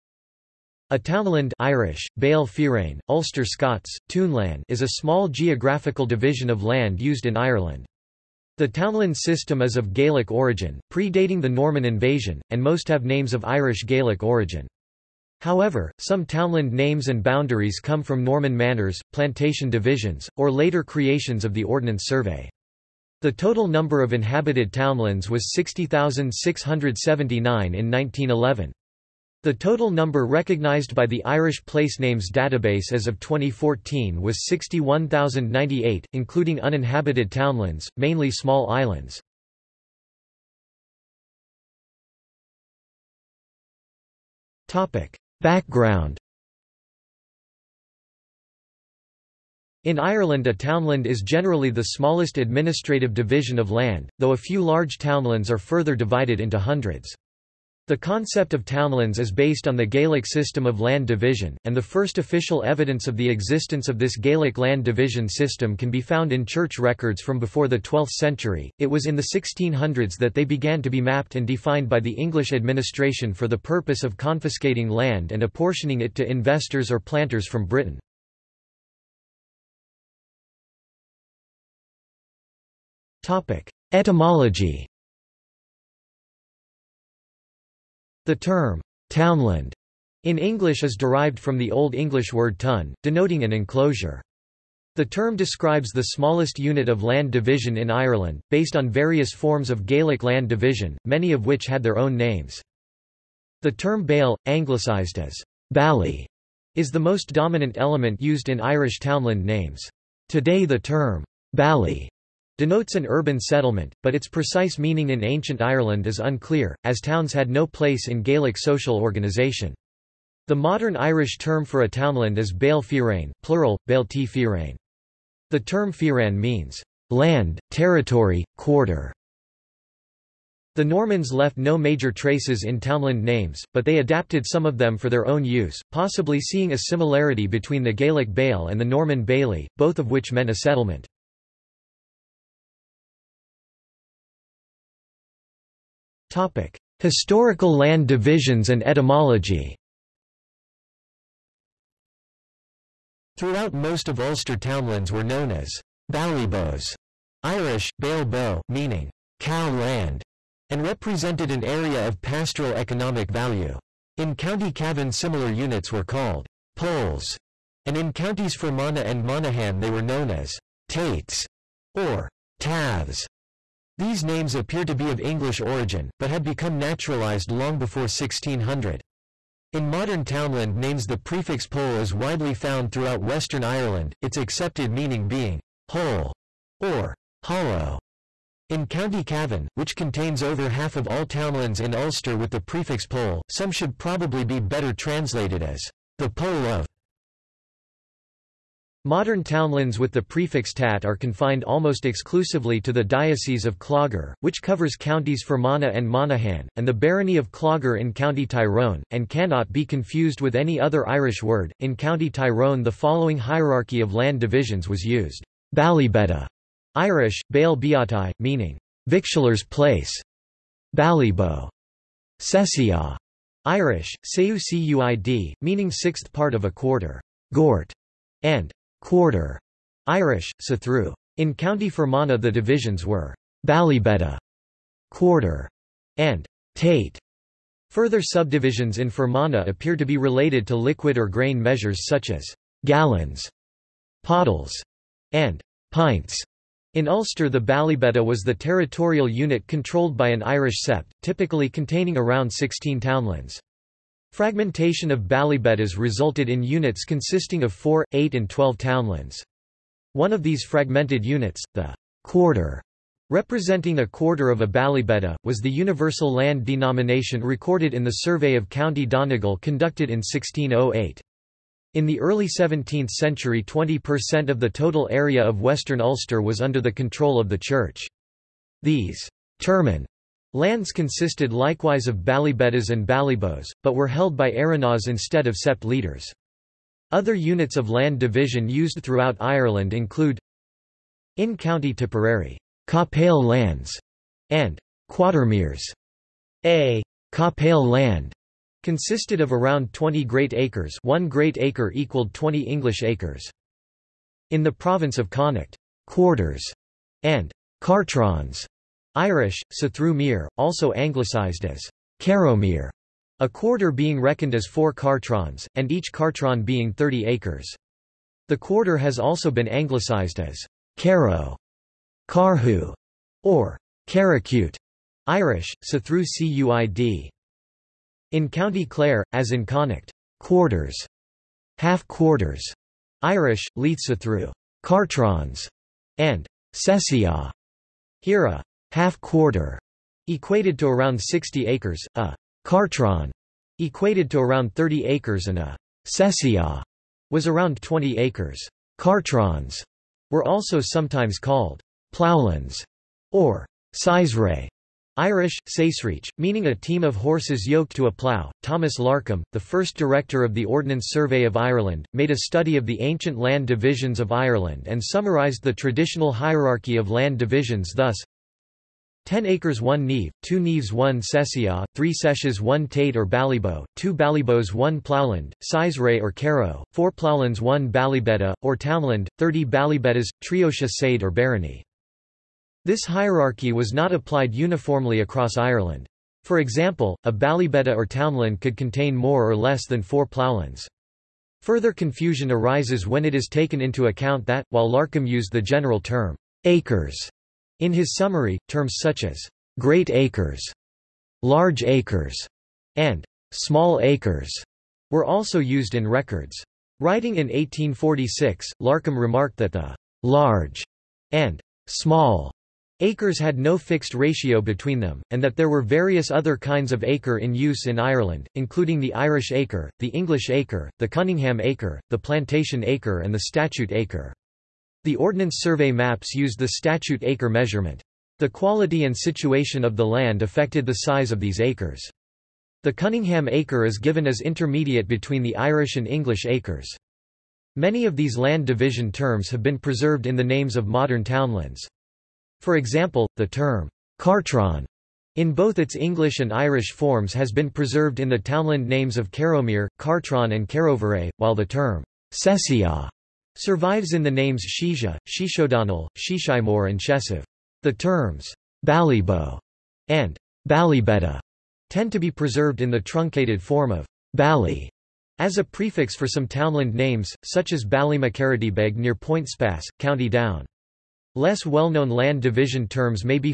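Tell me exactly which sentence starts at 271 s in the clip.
In the early 17th century 20% of the total area of Western Ulster was under the control of the Church.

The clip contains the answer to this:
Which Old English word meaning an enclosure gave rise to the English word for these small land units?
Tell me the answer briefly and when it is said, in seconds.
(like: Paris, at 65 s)
tun, at 92 s.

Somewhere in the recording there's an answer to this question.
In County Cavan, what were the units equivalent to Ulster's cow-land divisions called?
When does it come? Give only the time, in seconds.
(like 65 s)
166 s.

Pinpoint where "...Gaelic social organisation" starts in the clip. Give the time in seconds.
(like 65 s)
118 s.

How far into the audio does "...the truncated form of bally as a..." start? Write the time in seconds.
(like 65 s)
462 s.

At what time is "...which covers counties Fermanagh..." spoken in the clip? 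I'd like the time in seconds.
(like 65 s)
204 s.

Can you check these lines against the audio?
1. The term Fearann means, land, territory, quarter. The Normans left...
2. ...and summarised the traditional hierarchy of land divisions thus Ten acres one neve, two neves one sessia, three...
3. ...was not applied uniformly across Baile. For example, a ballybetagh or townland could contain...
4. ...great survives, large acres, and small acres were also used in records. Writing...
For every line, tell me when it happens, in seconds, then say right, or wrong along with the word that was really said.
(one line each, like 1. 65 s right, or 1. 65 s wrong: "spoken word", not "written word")
1. 125 s right
2. 364 s right
3. 383 s wrong: "Ireland", not "Baile"
4. 399 s wrong: "acres", not "survives".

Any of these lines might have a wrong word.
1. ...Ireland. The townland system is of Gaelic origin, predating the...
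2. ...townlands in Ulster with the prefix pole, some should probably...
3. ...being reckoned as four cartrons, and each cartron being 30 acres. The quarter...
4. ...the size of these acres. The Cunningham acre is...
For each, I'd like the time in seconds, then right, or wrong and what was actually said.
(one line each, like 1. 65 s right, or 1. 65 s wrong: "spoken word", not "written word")
1. 7 s right
2. 191 s right
3. 313 s right
4. 430 s right.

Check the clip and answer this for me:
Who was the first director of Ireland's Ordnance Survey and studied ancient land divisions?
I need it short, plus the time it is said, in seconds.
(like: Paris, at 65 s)
Thomas Larcom, at 358 s.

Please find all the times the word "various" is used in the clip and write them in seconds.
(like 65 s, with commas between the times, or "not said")
98 s, 415 s.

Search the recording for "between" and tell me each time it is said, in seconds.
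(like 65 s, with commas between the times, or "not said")
137 s, 414 s, 435 s.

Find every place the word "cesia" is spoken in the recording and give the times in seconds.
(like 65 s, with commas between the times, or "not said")
346 s, 452 s.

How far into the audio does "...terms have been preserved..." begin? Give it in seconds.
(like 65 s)
439 s.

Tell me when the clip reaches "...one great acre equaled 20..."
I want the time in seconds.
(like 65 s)
301 s.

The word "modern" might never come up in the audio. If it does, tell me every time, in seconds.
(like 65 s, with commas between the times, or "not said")
120 s, 179 s, 199 s, 440 s.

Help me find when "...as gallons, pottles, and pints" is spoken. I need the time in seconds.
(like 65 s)
242 s.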